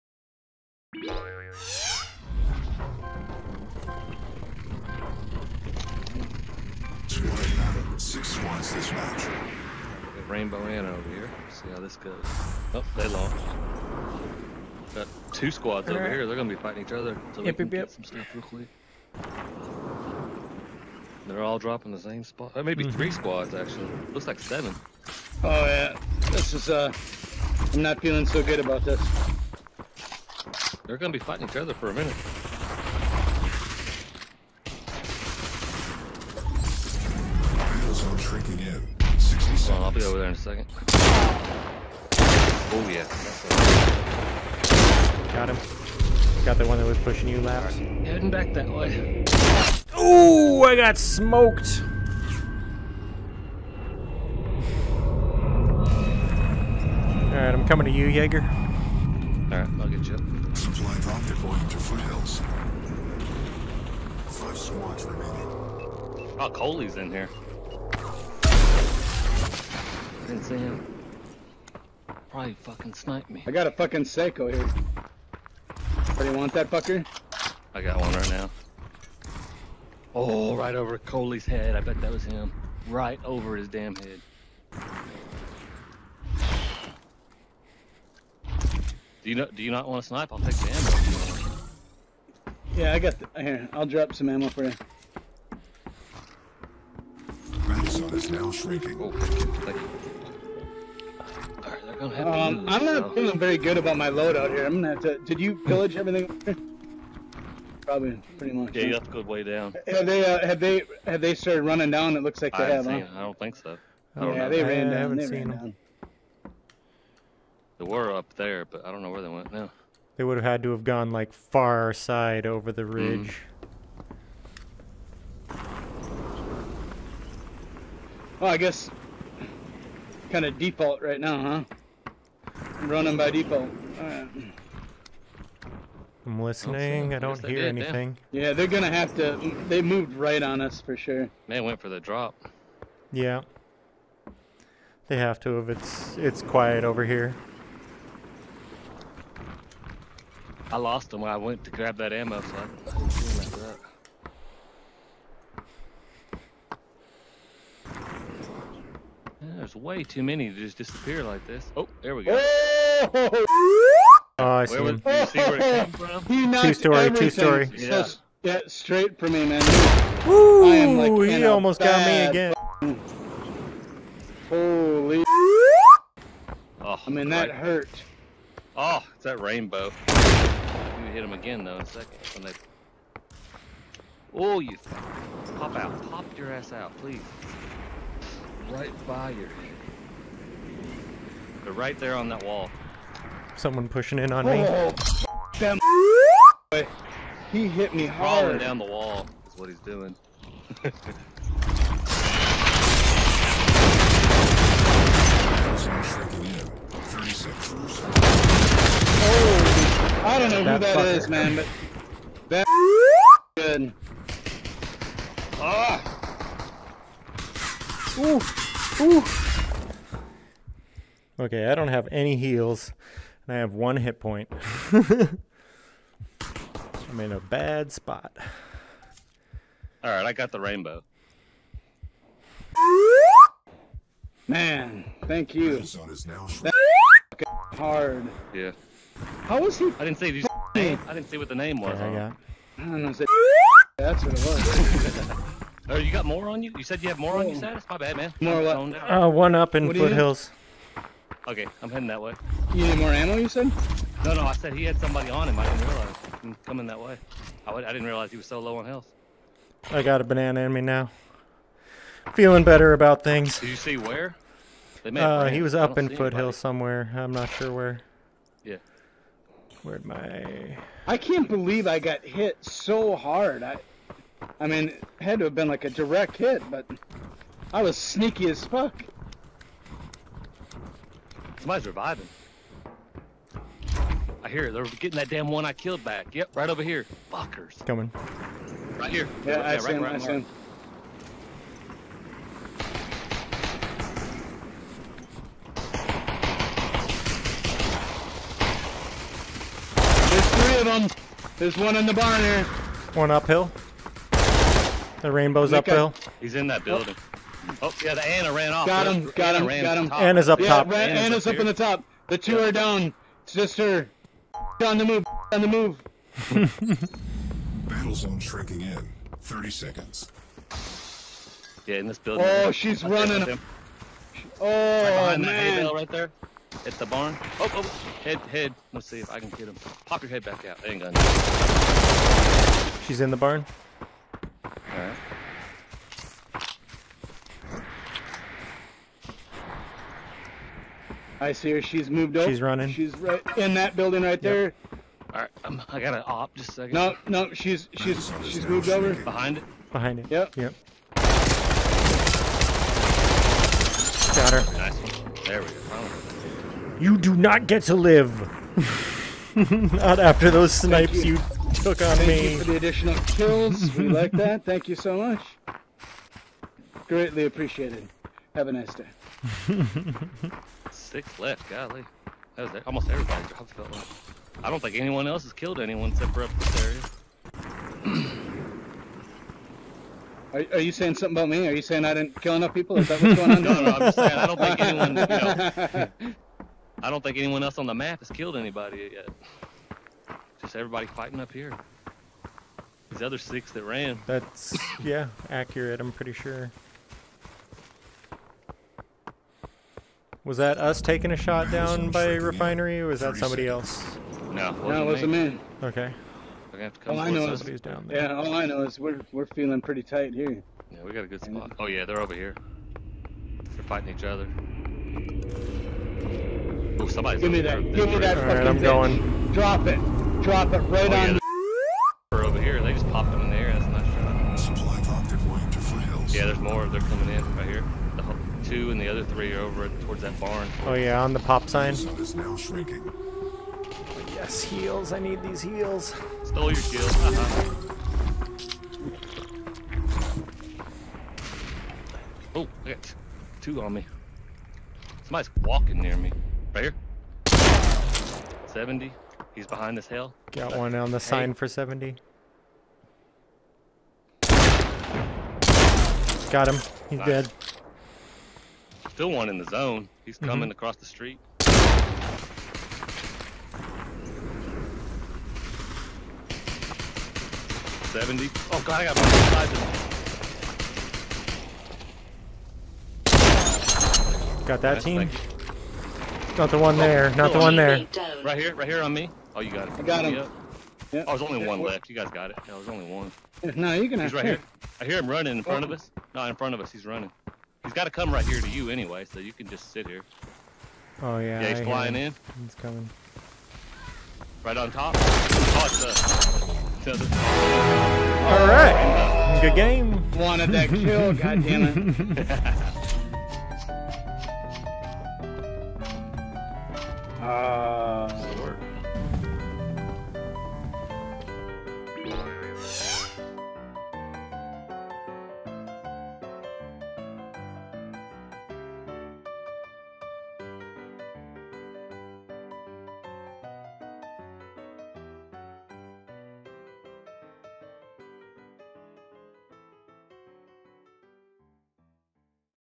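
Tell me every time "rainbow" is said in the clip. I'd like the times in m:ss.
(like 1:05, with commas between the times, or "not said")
0:10, 2:59, 3:50, 5:05.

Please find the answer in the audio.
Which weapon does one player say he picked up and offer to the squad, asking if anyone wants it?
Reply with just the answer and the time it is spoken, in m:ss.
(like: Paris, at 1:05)
Seiko, at 1:14.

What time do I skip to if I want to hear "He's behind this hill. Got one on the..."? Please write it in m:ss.
7:29.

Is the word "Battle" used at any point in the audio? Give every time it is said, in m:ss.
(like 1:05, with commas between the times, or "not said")
0:39, 5:17.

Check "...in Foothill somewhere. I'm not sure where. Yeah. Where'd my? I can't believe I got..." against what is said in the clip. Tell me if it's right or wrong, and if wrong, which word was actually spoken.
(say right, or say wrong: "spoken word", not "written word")
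right.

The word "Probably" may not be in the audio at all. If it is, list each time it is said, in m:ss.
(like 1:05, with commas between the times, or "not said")
1:12, 1:47.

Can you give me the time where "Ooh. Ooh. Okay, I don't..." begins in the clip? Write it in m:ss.
3:38.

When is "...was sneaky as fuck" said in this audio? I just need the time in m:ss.
4:37.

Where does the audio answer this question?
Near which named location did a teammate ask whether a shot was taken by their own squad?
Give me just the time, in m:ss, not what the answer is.
6:42.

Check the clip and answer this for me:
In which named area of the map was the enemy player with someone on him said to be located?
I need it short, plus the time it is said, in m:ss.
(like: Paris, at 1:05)
Foothills, at 4:09.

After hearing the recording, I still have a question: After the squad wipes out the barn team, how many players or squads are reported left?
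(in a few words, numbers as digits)
6.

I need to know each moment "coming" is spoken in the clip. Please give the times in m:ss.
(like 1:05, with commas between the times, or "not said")
0:57, 4:16, 4:47, 7:07, 7:40, 8:12.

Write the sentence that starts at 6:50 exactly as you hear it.
Yeah, we got a good spot.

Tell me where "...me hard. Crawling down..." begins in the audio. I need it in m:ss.
3:17.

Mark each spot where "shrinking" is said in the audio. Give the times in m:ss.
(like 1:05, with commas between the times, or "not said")
1:38, 5:18, 7:12.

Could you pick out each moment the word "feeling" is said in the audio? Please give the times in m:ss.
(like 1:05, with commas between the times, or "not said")
0:28, 1:43, 4:22, 6:49.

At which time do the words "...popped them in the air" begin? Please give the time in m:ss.
7:03.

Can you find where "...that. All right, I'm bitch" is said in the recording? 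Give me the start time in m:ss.
6:58.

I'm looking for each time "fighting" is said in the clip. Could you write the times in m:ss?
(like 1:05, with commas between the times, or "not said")
0:16, 0:31, 6:31, 6:53.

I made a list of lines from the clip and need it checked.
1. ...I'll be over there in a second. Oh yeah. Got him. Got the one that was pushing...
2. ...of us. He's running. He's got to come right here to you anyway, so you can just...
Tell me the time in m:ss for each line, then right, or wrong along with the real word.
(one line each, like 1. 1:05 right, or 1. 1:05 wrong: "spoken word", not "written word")
1. 0:39 right
2. 8:06 right.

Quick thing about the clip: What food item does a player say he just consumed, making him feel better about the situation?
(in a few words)
banana.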